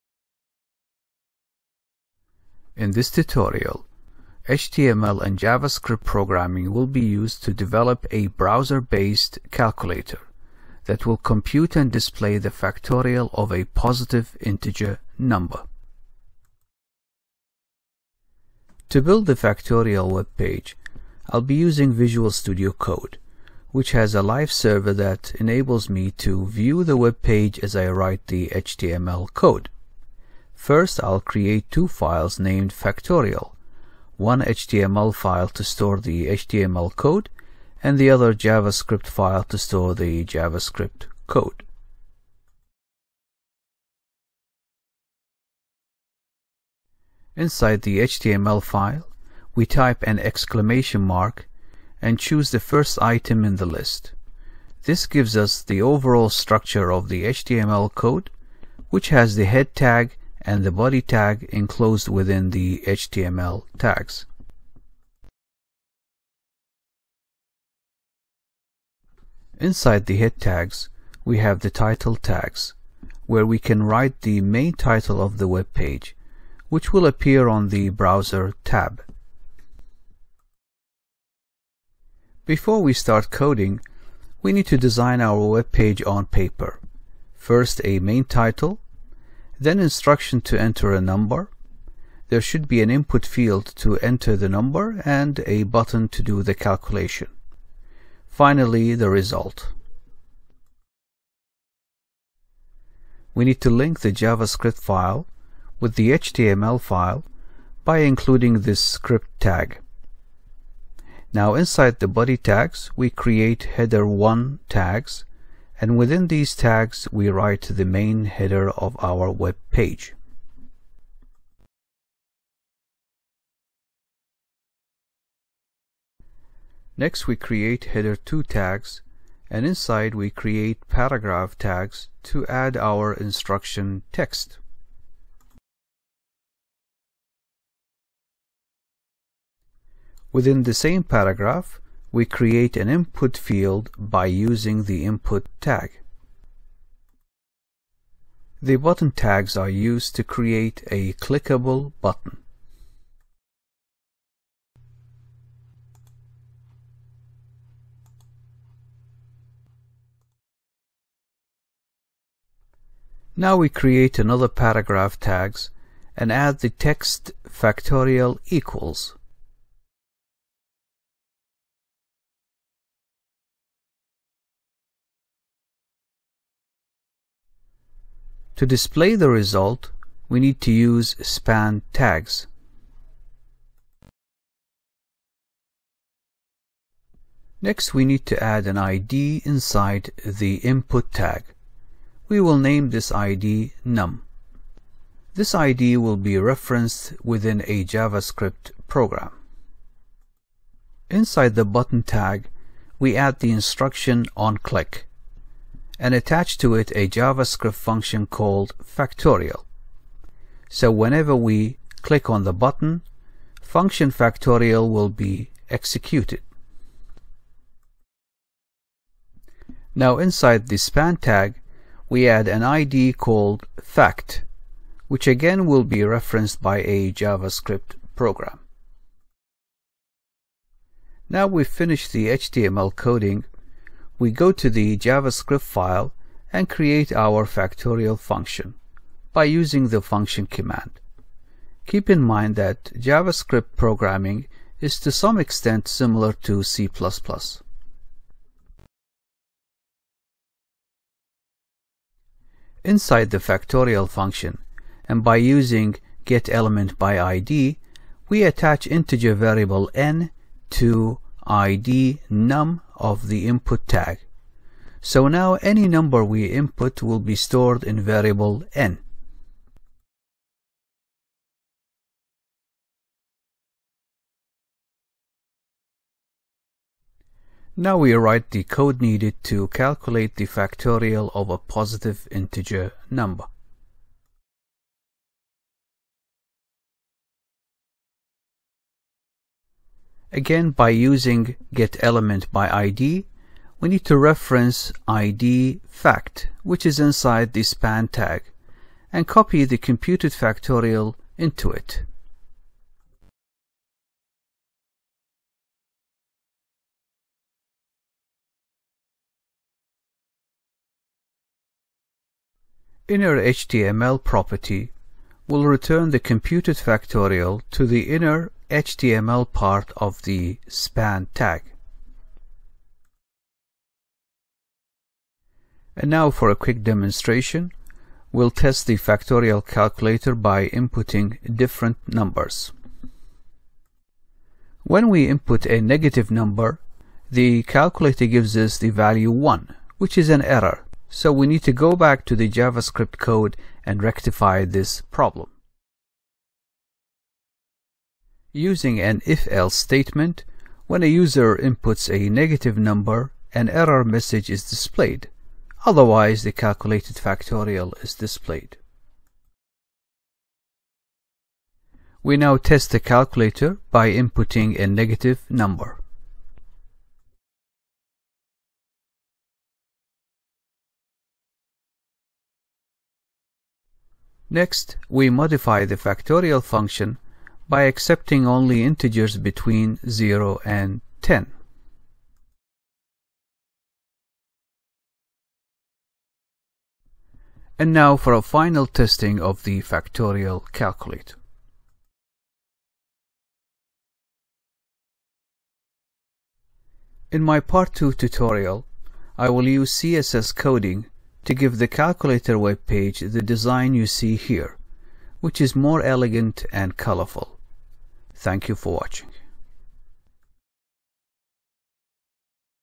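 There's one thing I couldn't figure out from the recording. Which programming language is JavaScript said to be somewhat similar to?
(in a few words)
C++.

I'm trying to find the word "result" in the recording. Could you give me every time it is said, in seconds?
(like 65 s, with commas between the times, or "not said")
99 s, 179 s.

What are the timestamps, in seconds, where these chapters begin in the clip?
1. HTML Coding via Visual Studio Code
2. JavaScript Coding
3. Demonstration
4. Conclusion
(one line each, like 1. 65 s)
1. 18 s
2. 210 s
3. 360 s
4. 396 s.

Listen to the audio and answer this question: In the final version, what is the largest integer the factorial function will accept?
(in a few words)
10.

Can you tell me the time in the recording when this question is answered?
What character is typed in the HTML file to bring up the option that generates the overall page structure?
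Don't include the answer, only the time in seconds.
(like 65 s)
50 s.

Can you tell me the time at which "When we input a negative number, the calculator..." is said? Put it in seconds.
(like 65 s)
334 s.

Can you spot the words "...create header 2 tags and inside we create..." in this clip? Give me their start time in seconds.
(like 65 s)
127 s.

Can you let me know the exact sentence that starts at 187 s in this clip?
Next, we need to add an ID inside the input tag.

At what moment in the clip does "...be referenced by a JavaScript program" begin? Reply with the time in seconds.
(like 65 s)
225 s.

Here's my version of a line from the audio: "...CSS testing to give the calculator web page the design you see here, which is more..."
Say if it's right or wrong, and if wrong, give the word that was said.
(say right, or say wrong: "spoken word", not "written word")
wrong: "coding", not "testing".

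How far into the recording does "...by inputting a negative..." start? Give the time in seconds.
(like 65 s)
363 s.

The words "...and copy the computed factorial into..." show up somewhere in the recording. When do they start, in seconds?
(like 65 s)
299 s.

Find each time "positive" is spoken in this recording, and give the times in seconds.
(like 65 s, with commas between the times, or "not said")
13 s, 281 s.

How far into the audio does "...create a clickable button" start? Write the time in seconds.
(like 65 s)
150 s.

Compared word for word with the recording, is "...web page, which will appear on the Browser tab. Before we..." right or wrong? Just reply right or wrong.
right.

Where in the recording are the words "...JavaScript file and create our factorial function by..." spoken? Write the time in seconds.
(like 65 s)
234 s.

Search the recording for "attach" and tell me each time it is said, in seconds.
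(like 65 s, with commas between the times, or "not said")
206 s, 258 s.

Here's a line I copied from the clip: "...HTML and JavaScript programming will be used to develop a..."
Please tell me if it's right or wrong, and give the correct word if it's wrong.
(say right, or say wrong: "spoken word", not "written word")
right.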